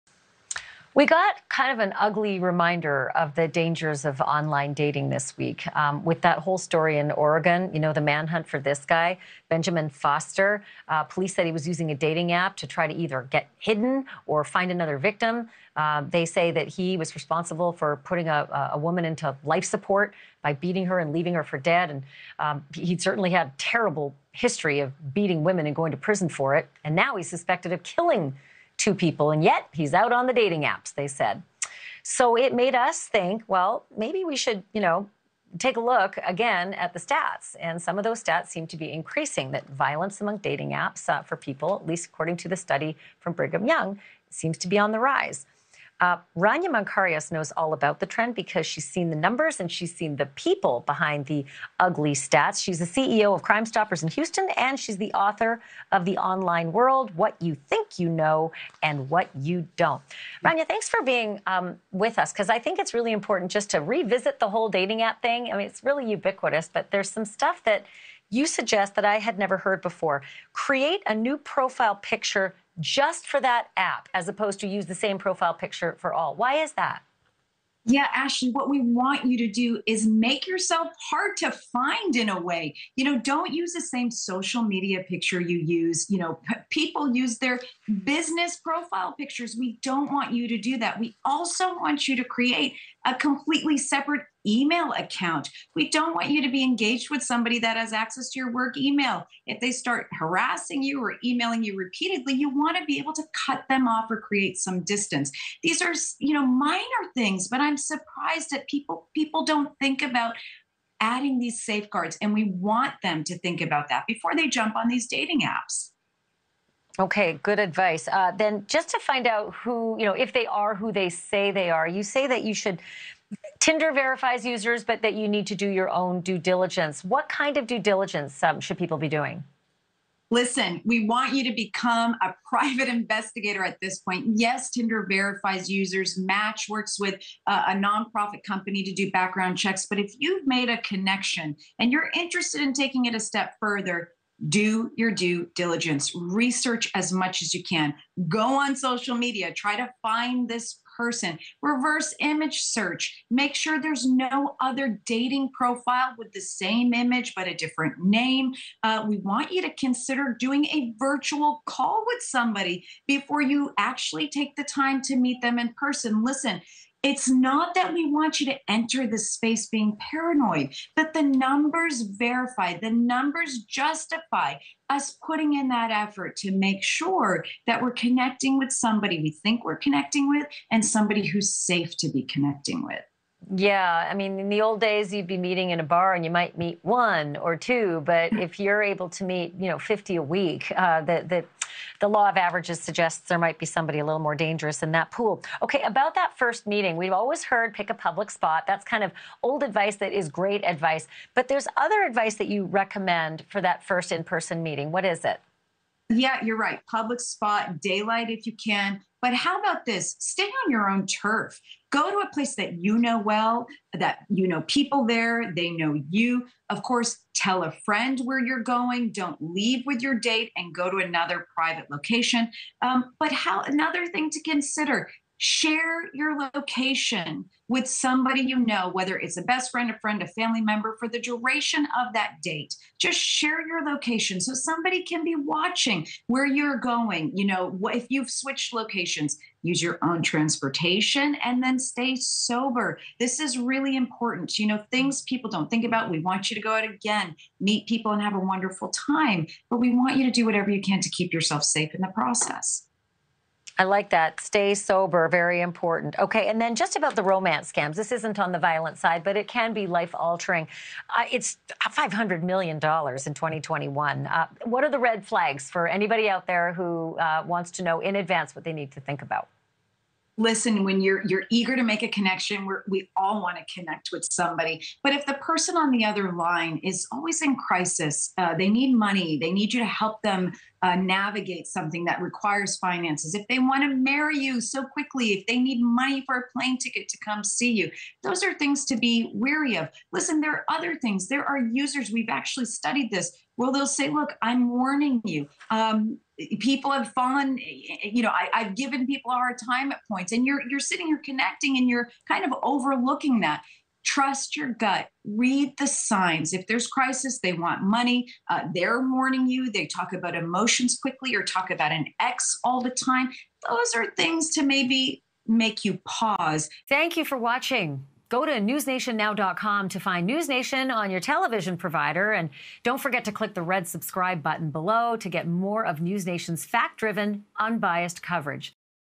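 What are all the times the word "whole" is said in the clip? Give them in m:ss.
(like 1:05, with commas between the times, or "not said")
0:06, 1:04.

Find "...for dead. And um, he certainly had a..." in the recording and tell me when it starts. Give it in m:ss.
0:21.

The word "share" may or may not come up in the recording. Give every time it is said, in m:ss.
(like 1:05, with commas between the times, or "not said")
3:45, 3:53.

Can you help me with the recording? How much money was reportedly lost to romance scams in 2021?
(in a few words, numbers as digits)
$500 million.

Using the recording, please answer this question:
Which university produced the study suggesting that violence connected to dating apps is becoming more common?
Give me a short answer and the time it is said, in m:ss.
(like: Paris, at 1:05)
Brigham Young, at 0:43.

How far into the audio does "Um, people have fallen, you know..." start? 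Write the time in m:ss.
4:55.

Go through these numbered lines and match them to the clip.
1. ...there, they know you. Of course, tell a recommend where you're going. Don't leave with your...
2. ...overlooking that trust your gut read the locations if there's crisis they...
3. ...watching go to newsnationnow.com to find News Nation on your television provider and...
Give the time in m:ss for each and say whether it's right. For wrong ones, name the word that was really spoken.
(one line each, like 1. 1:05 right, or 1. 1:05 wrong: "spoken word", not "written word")
1. 3:35 wrong: "friend", not "recommend"
2. 5:02 wrong: "signs", not "locations"
3. 5:17 right.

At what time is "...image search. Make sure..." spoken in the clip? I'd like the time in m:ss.
2:32.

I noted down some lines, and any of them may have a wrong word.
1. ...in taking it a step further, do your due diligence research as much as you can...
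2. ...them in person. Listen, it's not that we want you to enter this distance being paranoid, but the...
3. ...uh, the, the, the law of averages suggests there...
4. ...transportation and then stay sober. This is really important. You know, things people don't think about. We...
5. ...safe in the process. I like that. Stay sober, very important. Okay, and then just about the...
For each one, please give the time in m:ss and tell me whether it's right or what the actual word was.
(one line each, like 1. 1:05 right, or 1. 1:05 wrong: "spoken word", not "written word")
1. 2:22 right
2. 2:45 wrong: "space", not "distance"
3. 3:10 right
4. 4:00 right
5. 4:11 right.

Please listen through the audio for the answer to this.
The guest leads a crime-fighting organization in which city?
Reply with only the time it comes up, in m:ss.
0:54.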